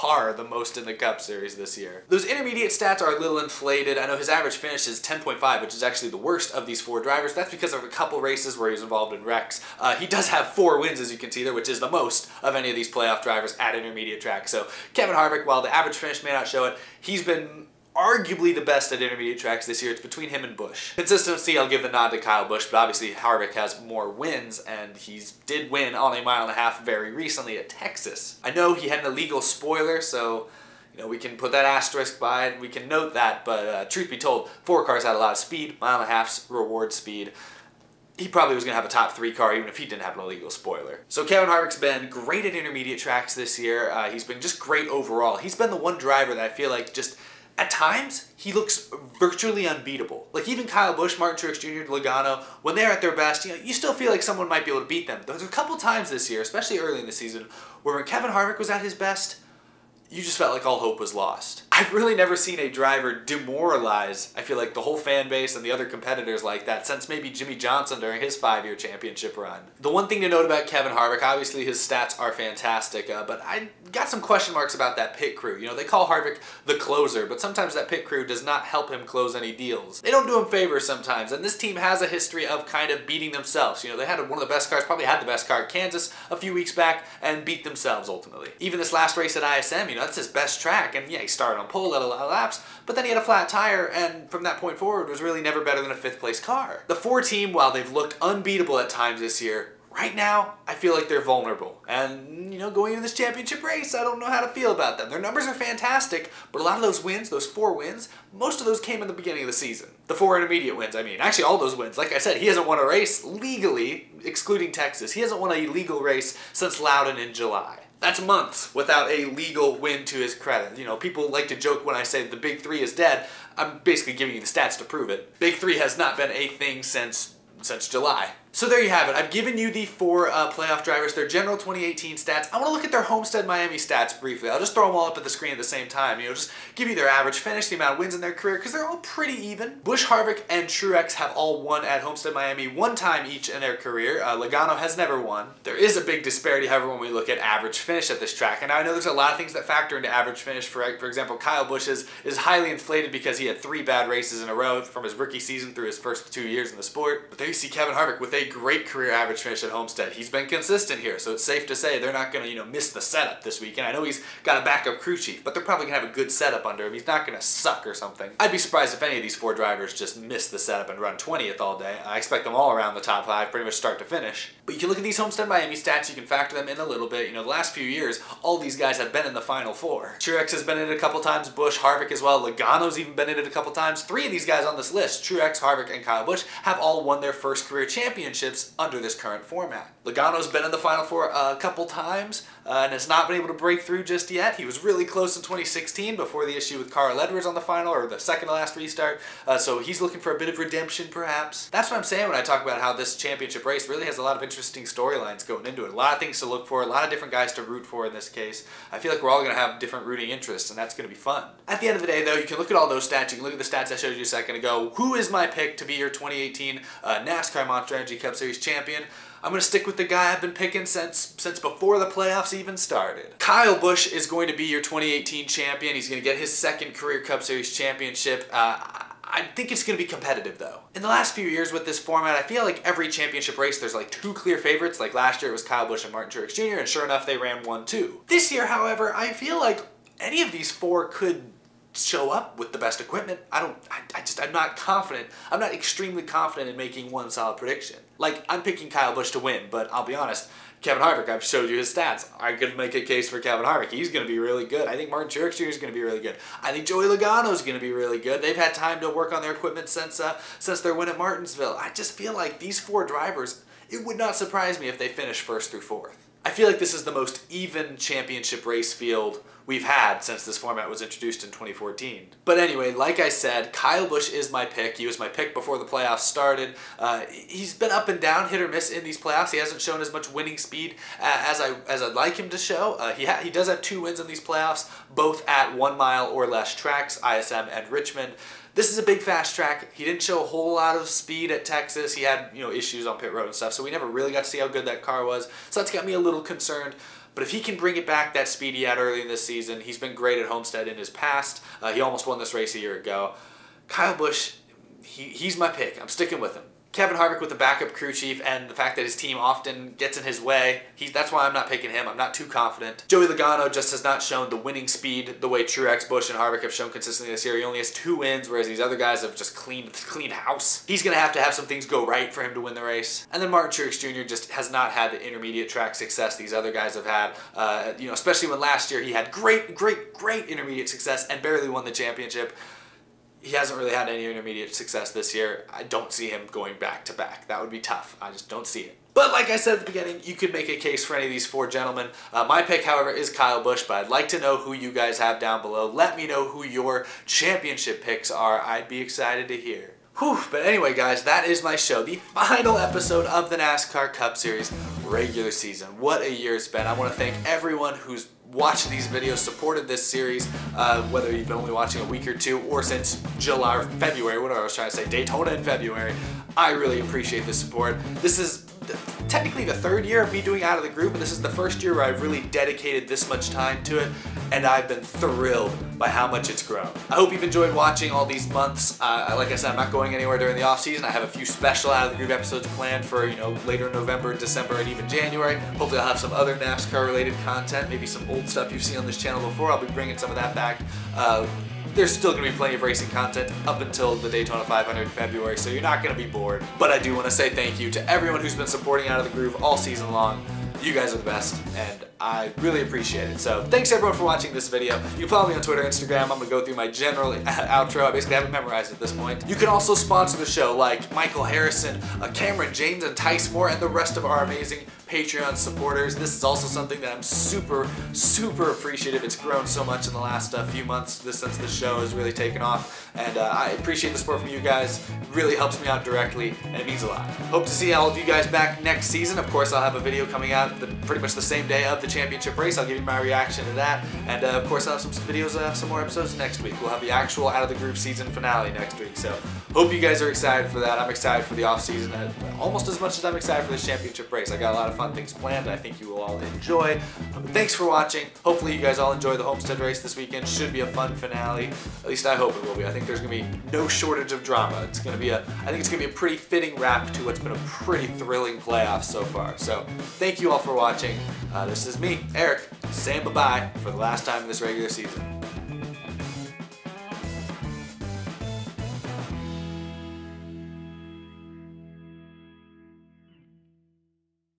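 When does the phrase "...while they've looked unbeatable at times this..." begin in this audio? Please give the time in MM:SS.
01:37.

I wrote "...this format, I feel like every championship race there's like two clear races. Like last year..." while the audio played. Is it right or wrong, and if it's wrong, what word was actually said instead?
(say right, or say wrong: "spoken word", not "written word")
wrong: "favorites", not "races".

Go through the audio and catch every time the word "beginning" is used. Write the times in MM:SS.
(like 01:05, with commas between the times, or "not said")
01:49, 05:39.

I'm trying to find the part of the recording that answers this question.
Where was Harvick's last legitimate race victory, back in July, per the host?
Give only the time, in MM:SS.
01:56.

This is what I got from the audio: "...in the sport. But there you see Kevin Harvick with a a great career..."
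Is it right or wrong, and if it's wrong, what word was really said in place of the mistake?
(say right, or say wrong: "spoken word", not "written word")
right.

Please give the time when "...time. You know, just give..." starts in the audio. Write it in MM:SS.
02:15.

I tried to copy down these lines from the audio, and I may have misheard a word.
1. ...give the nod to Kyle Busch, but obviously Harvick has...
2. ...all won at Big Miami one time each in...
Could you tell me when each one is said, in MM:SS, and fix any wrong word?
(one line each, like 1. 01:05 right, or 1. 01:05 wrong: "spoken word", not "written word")
1. 00:21 right
2. 02:21 wrong: "Homestead", not "Big".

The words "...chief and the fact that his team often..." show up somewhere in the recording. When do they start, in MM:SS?
05:08.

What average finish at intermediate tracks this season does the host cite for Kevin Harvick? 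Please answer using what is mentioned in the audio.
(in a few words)
10.5.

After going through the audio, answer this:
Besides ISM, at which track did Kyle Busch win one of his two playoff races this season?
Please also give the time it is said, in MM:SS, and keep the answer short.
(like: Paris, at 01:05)
Richmond, at 04:47.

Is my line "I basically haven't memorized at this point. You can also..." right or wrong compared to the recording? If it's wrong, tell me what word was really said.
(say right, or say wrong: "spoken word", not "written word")
right.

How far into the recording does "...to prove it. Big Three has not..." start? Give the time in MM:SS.
02:04.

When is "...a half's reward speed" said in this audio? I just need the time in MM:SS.
00:36.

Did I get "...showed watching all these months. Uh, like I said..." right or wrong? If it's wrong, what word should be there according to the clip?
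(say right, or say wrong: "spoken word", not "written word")
wrong: "enjoyed", not "showed".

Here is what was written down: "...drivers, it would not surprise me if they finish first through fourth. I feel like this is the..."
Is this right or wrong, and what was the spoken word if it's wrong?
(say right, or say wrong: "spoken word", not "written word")
right.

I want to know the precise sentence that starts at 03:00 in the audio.
Truex has been in it a couple times, Busch, Harvick as well, Logano's even been in it a couple times.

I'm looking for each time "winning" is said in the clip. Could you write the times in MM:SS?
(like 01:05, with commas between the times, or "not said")
04:40, 05:14.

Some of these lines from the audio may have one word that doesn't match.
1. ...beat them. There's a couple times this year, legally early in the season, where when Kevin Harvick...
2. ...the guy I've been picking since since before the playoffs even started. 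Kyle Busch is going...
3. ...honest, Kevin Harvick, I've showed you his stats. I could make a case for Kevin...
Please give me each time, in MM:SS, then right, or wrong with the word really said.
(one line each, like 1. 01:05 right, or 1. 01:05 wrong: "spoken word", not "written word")
1. 00:54 wrong: "especially", not "legally"
2. 03:39 right
3. 04:10 right.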